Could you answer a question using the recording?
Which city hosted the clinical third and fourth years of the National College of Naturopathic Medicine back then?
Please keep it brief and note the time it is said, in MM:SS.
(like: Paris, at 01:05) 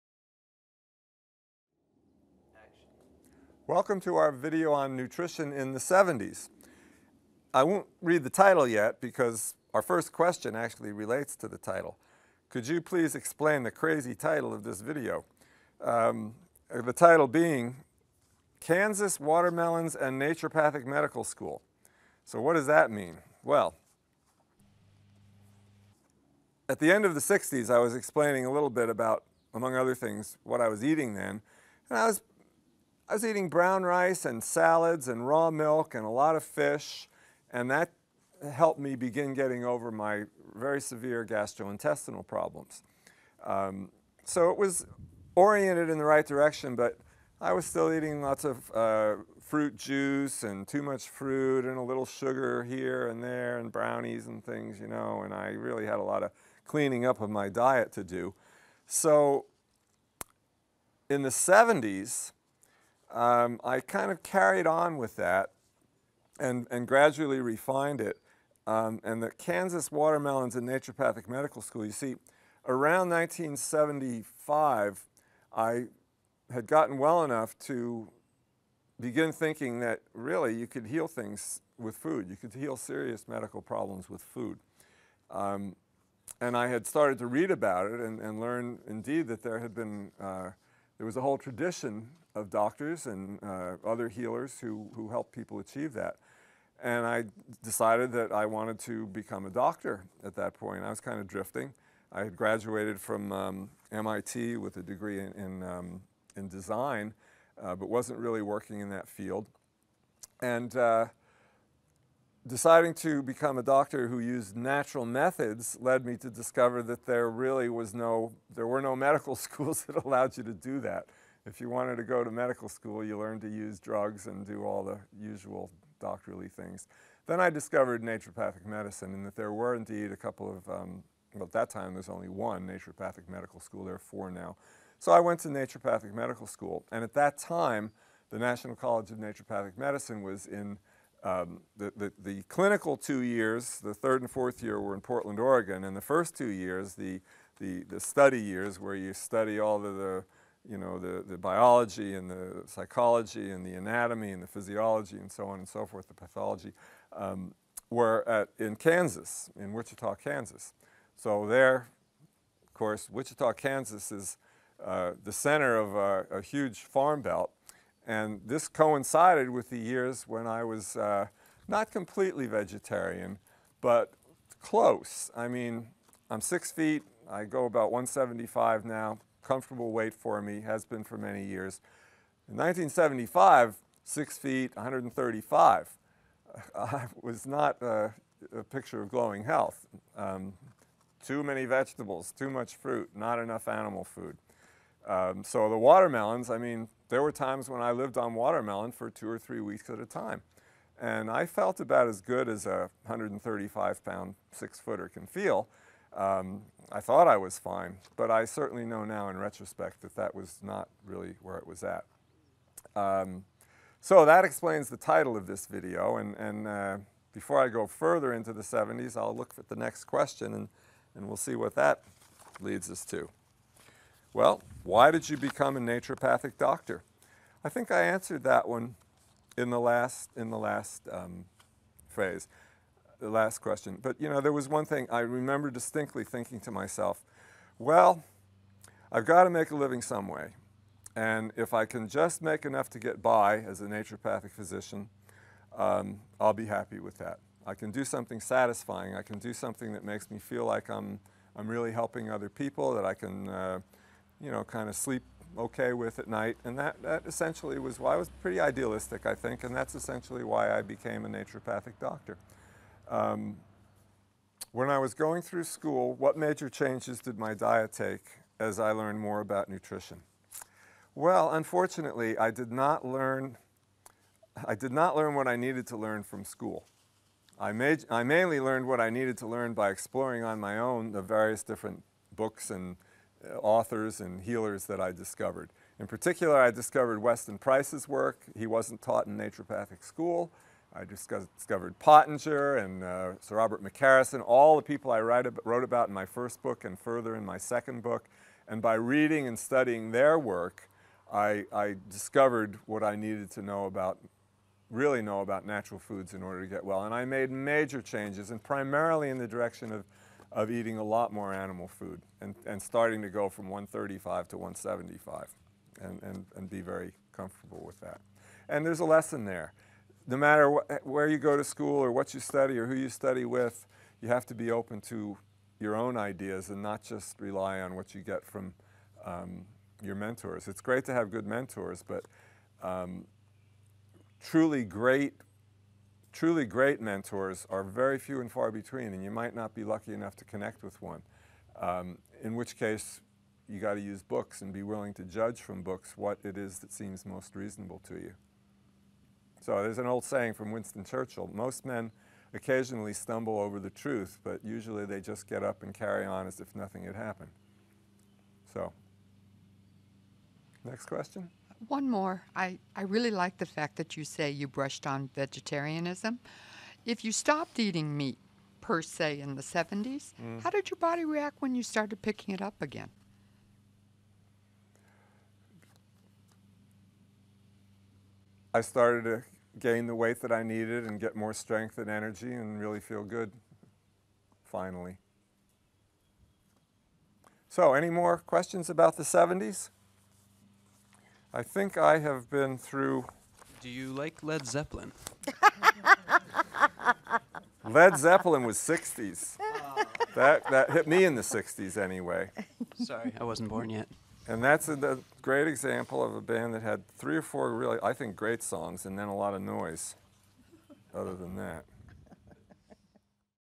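Portland, Oregon, at 02:25.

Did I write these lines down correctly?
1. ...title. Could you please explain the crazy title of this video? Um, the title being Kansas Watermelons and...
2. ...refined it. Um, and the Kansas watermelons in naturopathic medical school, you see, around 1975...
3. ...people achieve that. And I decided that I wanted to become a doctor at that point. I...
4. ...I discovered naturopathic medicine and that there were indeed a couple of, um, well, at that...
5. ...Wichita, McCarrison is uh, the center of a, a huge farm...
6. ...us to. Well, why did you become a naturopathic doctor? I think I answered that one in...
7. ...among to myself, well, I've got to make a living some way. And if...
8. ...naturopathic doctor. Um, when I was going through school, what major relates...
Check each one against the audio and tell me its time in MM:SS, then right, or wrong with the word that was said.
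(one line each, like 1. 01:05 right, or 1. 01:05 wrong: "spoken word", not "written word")
1. 00:11 right
2. 01:07 right
3. 01:35 right
4. 02:07 right
5. 02:43 wrong: "Kansas", not "McCarrison"
6. 03:42 right
7. 03:56 wrong: "thinking", not "among"
8. 04:21 wrong: "changes", not "relates".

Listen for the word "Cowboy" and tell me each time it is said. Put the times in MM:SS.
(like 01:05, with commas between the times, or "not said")
not said.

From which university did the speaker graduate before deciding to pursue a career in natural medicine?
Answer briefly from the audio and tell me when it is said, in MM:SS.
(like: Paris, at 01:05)
MIT, at 01:43.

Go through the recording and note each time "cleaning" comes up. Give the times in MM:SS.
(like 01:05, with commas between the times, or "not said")
00:56.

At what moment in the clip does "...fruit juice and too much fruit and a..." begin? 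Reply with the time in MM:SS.
00:49.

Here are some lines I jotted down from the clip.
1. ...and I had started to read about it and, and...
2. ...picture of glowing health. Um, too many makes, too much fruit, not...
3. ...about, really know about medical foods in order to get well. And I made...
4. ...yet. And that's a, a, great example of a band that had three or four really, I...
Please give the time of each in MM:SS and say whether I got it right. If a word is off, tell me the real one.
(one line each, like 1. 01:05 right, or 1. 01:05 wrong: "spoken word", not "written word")
1. 01:26 right
2. 03:08 wrong: "vegetables", not "makes"
3. 05:03 wrong: "natural", not "medical"
4. 06:43 right.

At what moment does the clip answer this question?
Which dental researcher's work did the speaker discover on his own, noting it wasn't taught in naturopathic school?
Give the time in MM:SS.
04:47.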